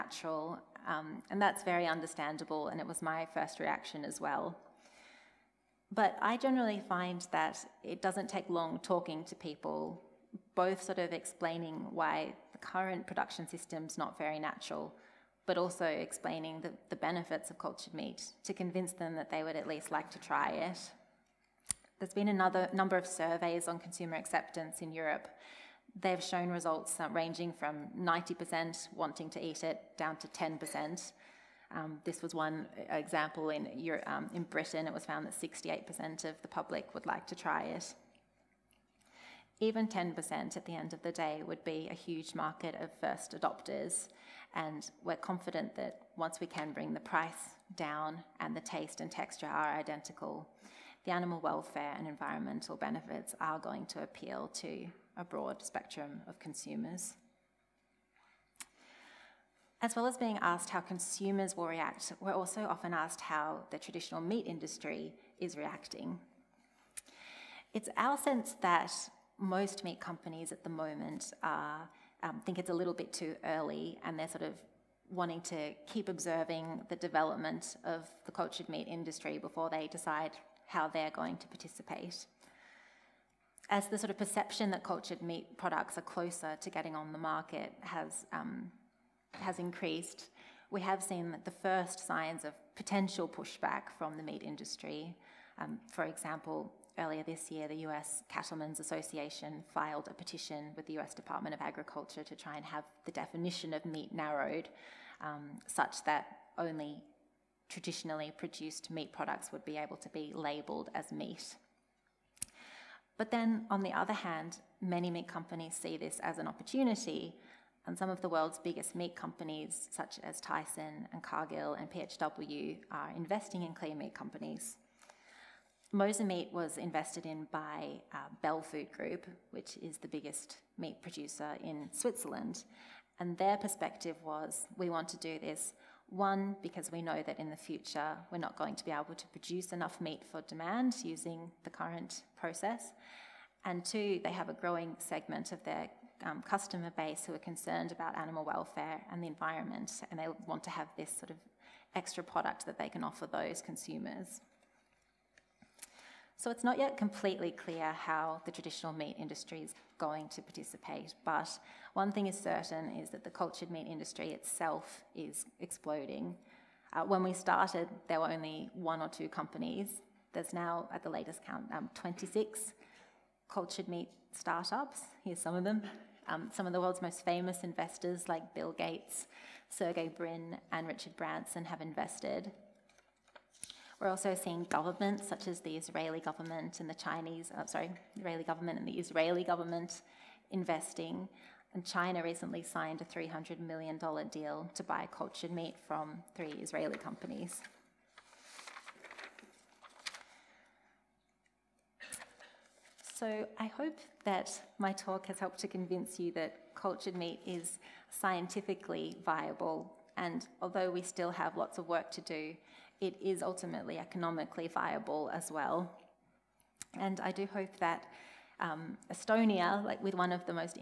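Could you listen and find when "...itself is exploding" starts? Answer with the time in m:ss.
2:44.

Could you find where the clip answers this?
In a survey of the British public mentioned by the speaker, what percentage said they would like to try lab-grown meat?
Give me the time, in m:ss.
0:35.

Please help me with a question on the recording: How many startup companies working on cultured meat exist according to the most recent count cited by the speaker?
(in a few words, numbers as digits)
26.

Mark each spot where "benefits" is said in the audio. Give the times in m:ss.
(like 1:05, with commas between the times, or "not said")
0:16, 0:52.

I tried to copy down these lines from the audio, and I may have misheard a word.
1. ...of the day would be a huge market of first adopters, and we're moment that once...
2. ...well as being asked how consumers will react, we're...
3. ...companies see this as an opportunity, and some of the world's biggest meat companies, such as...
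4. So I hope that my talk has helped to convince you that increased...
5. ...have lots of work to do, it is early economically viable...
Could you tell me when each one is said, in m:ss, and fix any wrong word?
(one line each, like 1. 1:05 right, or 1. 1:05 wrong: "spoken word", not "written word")
1. 0:40 wrong: "confident", not "moment"
2. 0:59 right
3. 1:55 right
4. 3:23 wrong: "cultured", not "increased"
5. 3:31 wrong: "ultimately", not "early".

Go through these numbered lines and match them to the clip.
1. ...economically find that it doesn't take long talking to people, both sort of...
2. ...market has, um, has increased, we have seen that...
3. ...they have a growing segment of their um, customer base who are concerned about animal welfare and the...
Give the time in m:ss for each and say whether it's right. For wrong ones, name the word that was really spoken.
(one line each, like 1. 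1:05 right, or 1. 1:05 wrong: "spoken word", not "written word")
1. 0:06 wrong: "generally", not "economically"
2. 1:27 right
3. 2:24 right.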